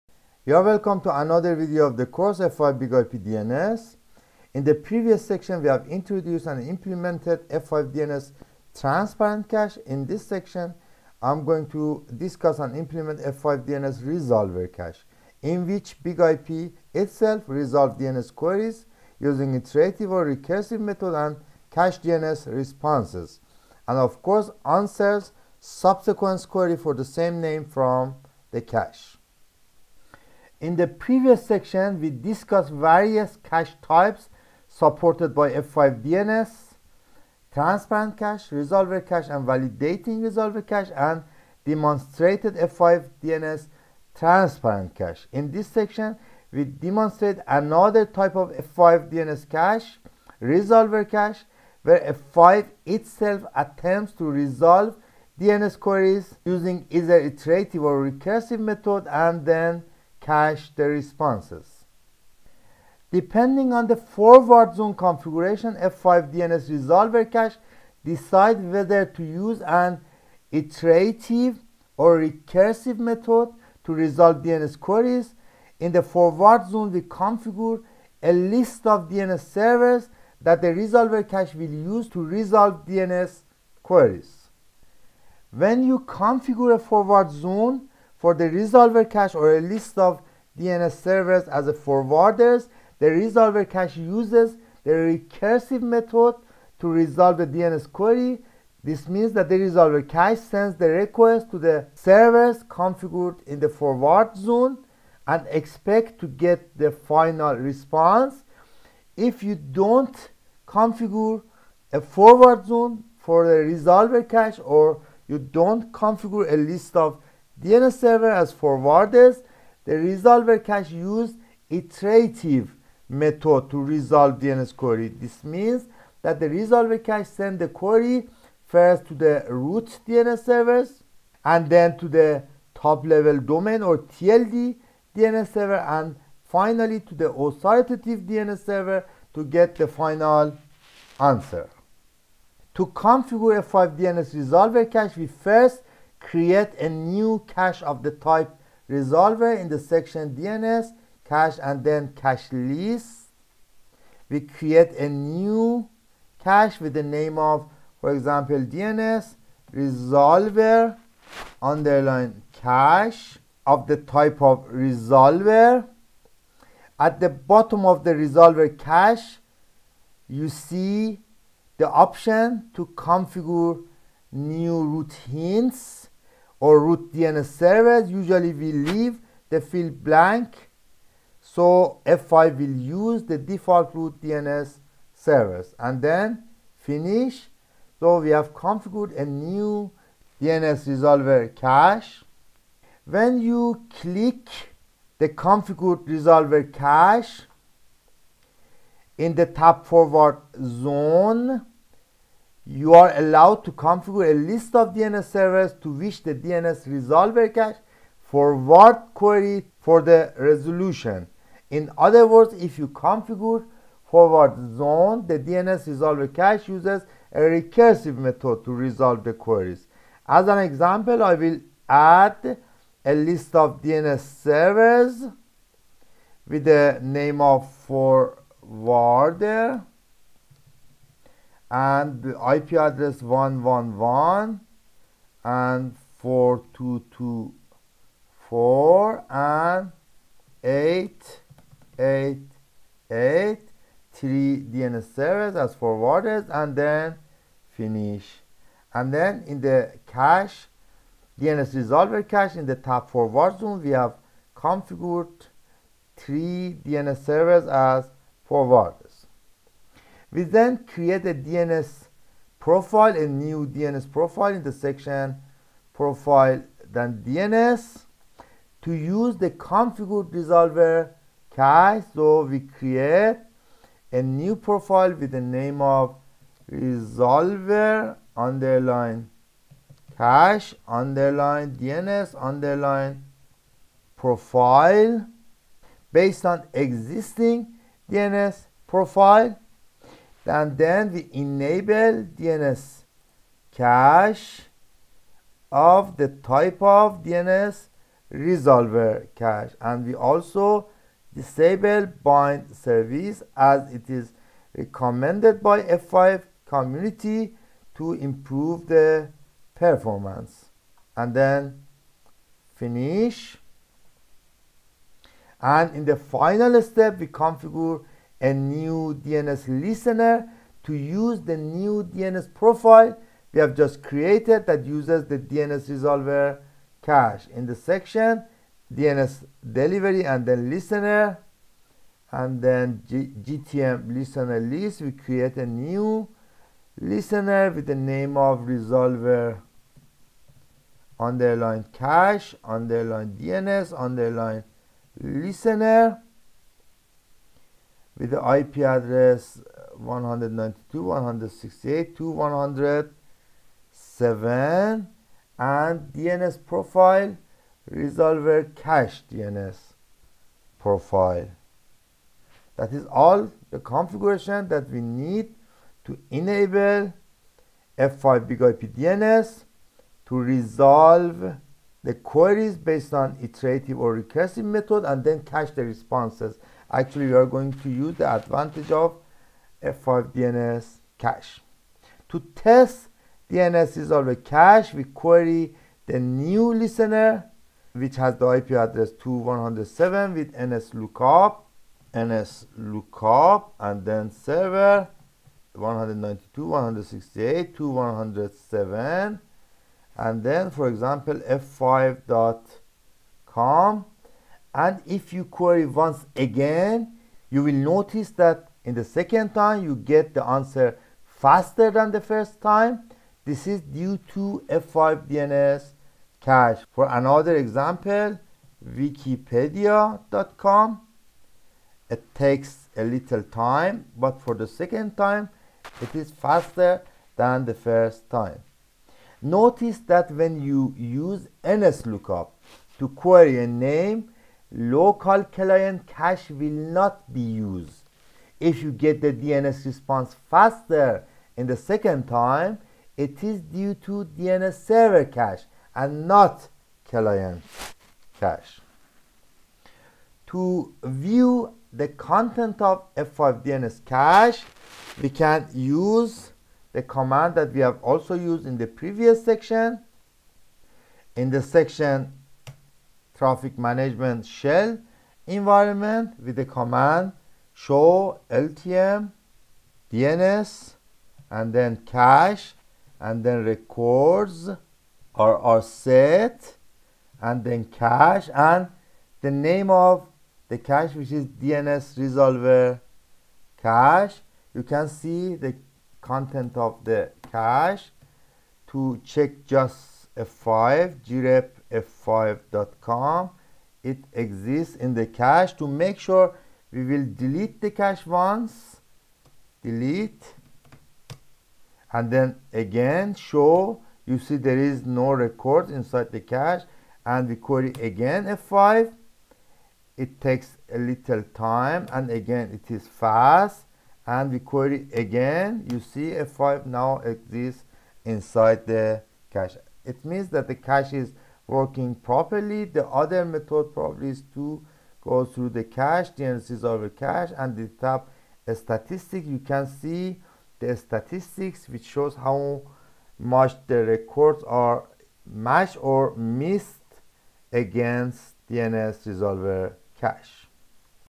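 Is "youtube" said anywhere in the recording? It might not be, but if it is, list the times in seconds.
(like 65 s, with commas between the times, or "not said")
not said.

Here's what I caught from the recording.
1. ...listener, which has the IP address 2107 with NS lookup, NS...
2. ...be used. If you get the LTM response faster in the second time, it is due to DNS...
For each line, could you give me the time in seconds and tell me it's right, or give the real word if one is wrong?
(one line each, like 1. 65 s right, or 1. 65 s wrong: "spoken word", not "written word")
1. 386 s right
2. 437 s wrong: "DNS", not "LTM".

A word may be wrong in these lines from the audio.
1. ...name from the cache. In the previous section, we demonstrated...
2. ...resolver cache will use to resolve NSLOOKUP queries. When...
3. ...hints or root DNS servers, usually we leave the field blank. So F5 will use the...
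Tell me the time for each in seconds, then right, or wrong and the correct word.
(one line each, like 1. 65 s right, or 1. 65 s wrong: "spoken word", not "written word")
1. 27 s wrong: "discussed", not "demonstrated"
2. 80 s wrong: "DNS", not "NSLOOKUP"
3. 175 s right.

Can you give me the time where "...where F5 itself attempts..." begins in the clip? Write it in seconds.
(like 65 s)
51 s.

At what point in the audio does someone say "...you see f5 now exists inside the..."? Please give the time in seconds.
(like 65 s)
515 s.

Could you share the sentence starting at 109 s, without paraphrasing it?
If you don't configure a forward zone for the resolver cache or you don't configure a list of DNS server has forwarders.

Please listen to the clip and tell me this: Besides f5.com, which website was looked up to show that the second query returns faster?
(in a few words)
wikipedia.com.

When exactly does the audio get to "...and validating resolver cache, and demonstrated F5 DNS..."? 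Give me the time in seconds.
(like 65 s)
39 s.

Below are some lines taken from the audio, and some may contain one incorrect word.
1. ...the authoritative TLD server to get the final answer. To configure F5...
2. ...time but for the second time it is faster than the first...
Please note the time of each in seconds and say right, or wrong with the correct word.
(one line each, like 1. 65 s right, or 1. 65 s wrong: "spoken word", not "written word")
1. 137 s wrong: "DNS", not "TLD"
2. 423 s right.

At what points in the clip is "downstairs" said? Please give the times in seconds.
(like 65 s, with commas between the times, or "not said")
not said.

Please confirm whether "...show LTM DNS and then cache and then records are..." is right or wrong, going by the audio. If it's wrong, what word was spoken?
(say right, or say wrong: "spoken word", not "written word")
right.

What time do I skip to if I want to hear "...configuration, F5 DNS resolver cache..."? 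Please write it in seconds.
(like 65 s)
64 s.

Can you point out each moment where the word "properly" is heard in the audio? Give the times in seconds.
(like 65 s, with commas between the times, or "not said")
522 s.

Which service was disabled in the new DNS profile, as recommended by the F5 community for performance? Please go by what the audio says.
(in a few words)
Bind.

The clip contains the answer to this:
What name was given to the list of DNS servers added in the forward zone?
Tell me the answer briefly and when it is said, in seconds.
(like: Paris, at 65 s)
forwarder, at 227 s.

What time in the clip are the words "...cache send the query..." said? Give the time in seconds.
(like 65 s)
127 s.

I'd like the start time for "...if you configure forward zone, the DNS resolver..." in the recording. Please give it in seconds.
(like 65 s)
212 s.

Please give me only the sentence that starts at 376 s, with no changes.
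Actually, we are going to use the advantage of F5DNS cache.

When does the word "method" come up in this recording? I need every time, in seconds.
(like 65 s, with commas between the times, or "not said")
20 s, 58 s, 72 s, 95 s, 123 s, 218 s, 374 s, 523 s.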